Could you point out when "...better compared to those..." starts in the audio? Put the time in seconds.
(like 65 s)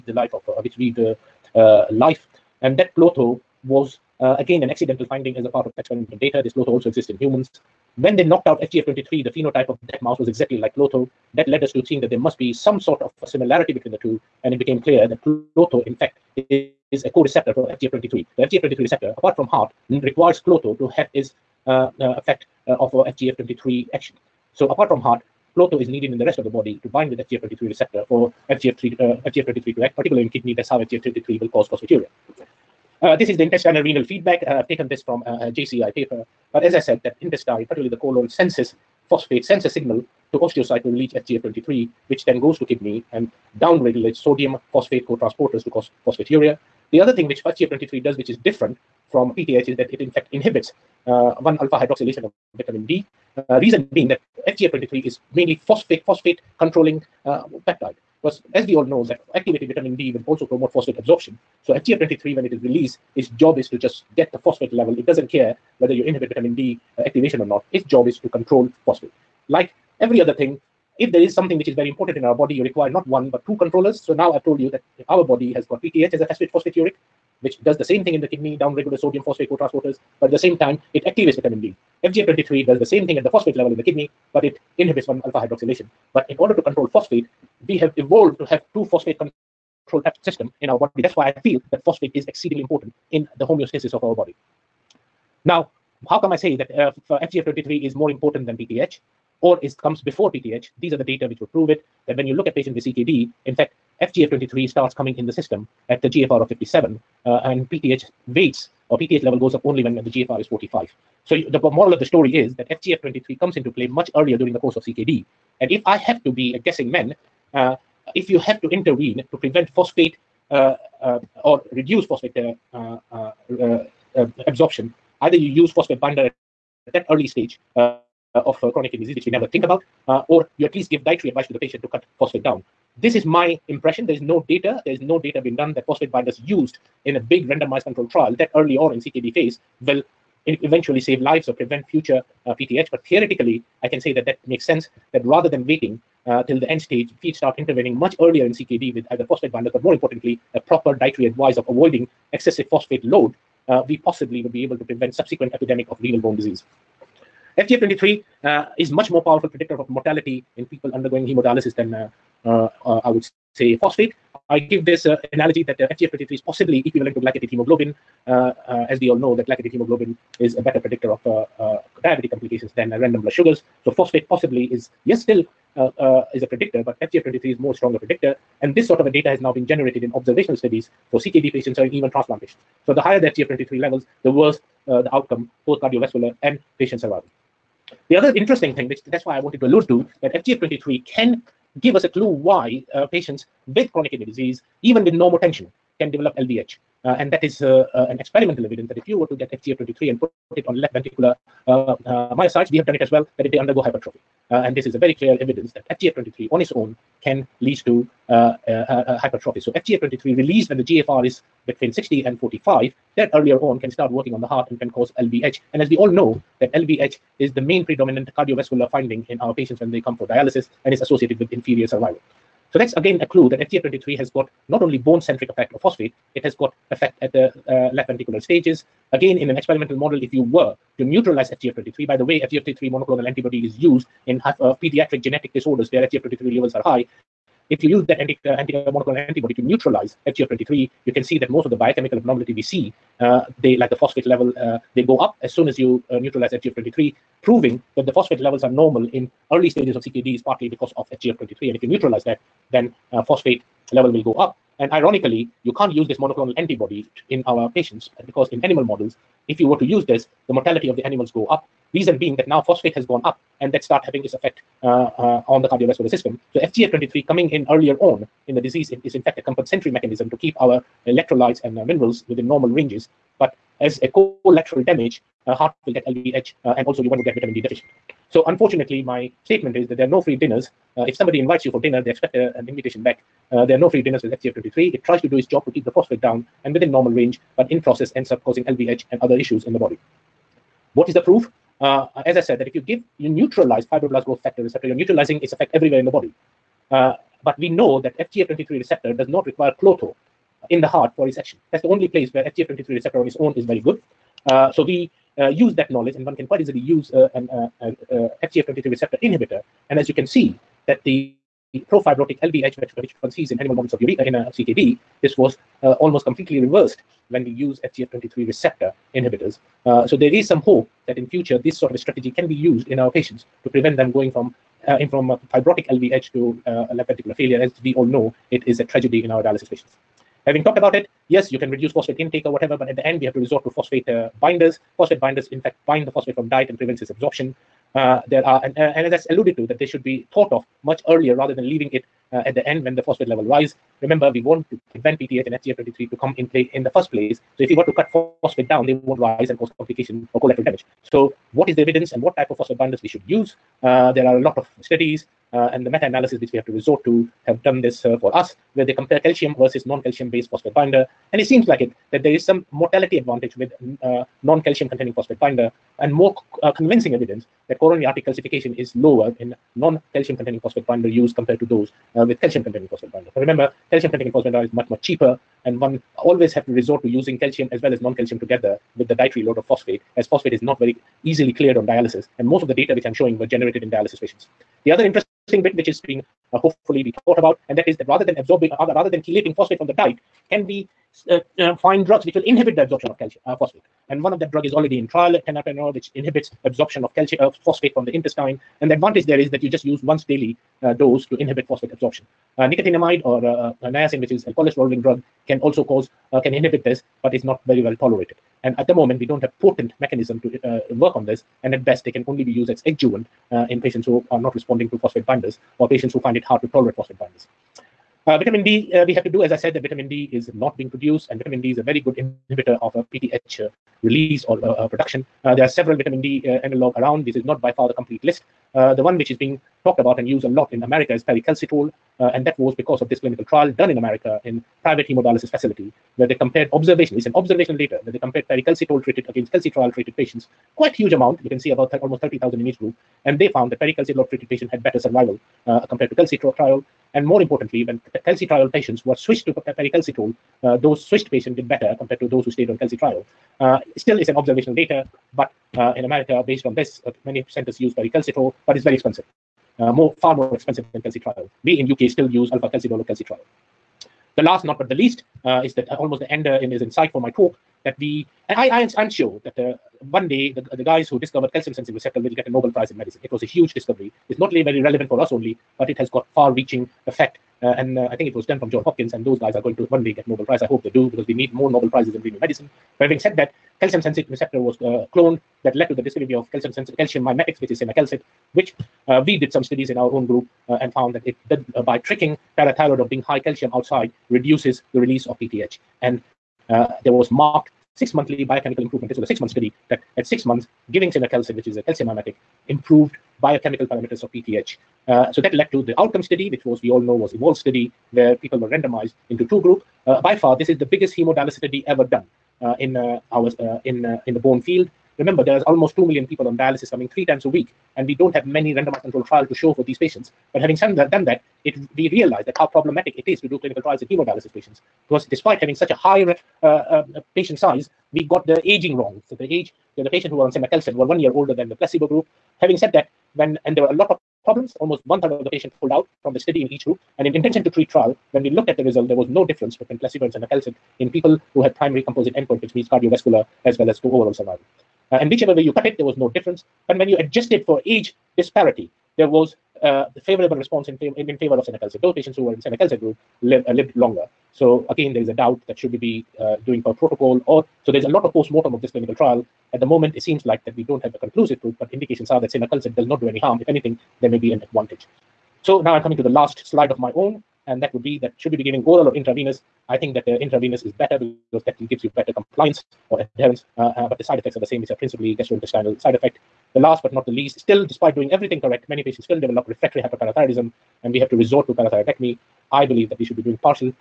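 451 s.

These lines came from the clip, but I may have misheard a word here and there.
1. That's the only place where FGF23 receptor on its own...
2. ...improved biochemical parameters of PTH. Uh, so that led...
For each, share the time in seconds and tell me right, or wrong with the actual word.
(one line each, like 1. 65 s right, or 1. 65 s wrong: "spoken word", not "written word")
1. 301 s right
2. 502 s right.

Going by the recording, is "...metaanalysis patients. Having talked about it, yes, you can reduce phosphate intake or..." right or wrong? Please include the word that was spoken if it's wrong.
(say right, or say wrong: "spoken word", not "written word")
wrong: "dialysis", not "metaanalysis".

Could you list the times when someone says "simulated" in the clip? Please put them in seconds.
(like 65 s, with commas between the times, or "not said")
not said.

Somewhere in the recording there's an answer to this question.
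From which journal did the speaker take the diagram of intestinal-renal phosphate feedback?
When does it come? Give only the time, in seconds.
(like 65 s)
35 s.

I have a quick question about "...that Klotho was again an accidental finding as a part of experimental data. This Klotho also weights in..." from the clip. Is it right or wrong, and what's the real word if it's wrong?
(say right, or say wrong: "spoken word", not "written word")
wrong: "exists", not "weights".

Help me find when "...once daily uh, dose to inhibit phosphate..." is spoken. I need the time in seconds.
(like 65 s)
400 s.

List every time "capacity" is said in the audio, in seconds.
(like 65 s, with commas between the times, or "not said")
not said.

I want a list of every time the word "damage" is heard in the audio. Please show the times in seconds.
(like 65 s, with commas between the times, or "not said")
274 s, 350 s.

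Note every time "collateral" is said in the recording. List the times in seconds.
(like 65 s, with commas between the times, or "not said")
274 s, 350 s.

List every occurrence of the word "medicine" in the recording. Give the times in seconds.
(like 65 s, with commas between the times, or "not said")
472 s, 482 s.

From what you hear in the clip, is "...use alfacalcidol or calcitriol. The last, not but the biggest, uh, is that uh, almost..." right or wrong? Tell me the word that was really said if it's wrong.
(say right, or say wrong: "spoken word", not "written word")
wrong: "least", not "biggest".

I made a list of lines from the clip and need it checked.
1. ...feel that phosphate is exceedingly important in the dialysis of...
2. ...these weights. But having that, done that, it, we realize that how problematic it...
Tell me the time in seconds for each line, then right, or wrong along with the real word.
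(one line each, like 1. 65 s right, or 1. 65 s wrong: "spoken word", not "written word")
1. 91 s wrong: "homeostasis", not "dialysis"
2. 519 s wrong: "patients", not "weights".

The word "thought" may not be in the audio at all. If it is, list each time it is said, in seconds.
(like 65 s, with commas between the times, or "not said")
340 s, 387 s.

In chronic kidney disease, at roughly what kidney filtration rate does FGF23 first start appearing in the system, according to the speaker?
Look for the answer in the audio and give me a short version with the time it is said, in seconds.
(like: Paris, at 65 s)
57, at 106 s.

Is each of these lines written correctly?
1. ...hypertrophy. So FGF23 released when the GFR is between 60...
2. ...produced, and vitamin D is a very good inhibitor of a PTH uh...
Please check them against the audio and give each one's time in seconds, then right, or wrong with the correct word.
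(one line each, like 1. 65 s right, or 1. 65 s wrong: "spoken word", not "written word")
1. 209 s right
2. 420 s right.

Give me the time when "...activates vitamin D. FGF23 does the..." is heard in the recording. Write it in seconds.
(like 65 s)
81 s.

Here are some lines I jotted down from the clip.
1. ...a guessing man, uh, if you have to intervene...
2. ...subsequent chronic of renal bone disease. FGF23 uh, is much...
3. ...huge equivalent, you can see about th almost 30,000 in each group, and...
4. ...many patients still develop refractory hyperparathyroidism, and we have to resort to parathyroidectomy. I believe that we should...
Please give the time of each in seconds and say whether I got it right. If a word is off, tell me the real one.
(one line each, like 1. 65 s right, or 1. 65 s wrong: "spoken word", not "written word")
1. 116 s right
2. 155 s wrong: "epidemic", not "chronic"
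3. 440 s wrong: "amount", not "equivalent"
4. 578 s right.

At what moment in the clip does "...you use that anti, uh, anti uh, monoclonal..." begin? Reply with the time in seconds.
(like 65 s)
237 s.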